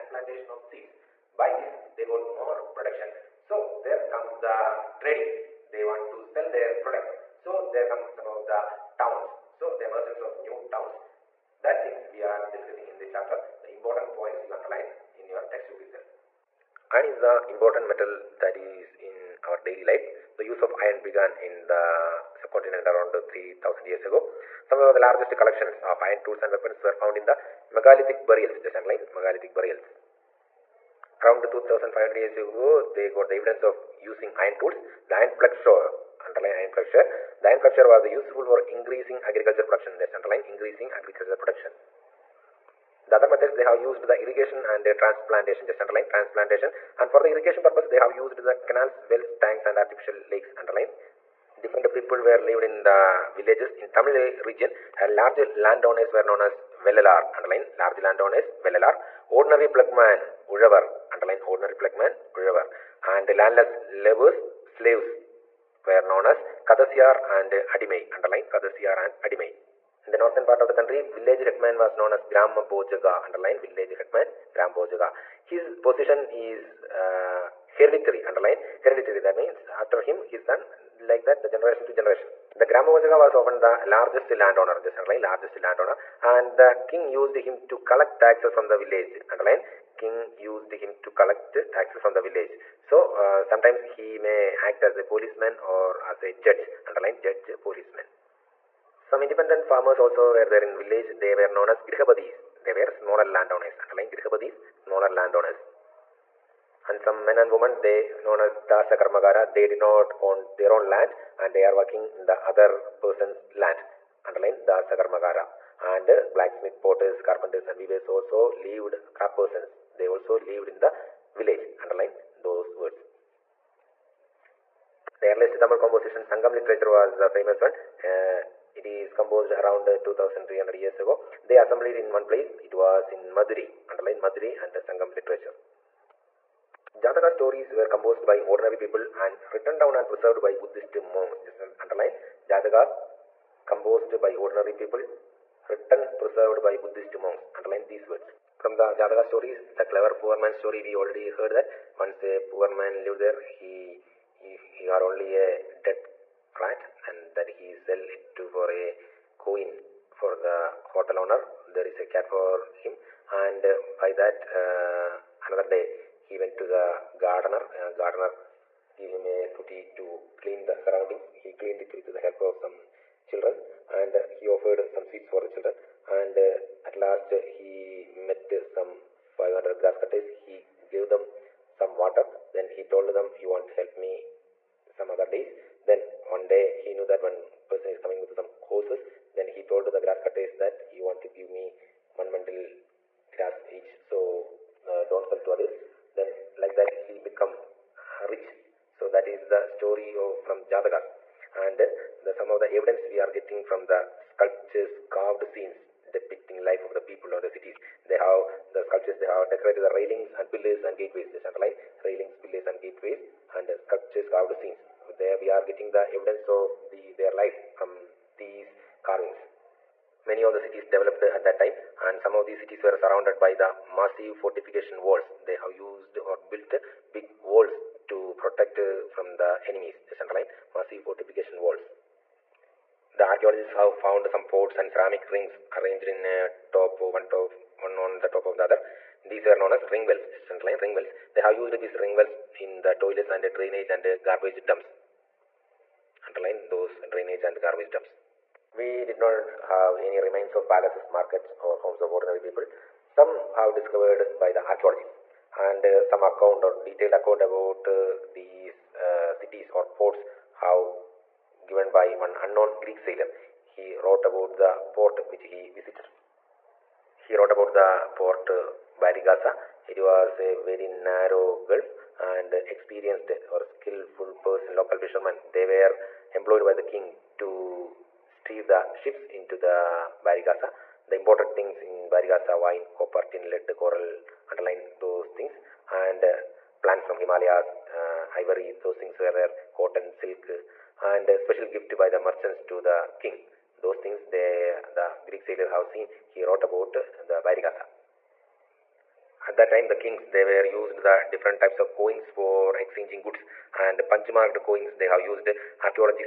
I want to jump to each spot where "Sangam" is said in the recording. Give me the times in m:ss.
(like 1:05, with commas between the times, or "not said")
2:06, 2:14.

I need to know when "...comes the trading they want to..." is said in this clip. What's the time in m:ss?
0:04.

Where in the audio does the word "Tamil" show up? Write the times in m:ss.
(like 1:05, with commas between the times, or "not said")
0:53, 2:05.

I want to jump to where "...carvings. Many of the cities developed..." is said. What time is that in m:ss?
3:39.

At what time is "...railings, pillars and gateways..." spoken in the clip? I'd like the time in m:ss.
3:32.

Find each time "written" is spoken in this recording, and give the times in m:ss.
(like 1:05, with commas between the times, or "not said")
2:19, 2:25.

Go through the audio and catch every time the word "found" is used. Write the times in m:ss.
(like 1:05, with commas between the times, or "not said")
0:26, 3:54.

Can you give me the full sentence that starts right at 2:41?
There is a cat for him and by that uh, another day he went to the gardener.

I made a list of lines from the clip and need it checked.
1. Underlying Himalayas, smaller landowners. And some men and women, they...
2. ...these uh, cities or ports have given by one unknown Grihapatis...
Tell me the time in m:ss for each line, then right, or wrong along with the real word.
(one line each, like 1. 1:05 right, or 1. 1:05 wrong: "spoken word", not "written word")
1. 1:43 wrong: "Grihapatis", not "Himalayas"
2. 4:18 wrong: "Greek", not "Grihapatis".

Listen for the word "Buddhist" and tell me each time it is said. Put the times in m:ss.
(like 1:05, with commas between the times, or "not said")
2:20, 2:26.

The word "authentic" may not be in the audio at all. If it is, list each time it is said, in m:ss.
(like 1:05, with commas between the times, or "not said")
not said.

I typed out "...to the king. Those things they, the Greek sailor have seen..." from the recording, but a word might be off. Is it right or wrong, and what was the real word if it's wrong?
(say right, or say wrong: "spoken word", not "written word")
right.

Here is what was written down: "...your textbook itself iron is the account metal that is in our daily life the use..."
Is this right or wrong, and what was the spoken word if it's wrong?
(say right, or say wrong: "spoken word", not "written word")
wrong: "important", not "account".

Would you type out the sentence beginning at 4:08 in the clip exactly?
We did not have any remains of palaces, markets, or homes of ordinary people.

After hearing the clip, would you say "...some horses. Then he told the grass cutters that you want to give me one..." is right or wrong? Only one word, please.
right.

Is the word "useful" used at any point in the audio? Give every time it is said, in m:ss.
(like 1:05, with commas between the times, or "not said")
0:38.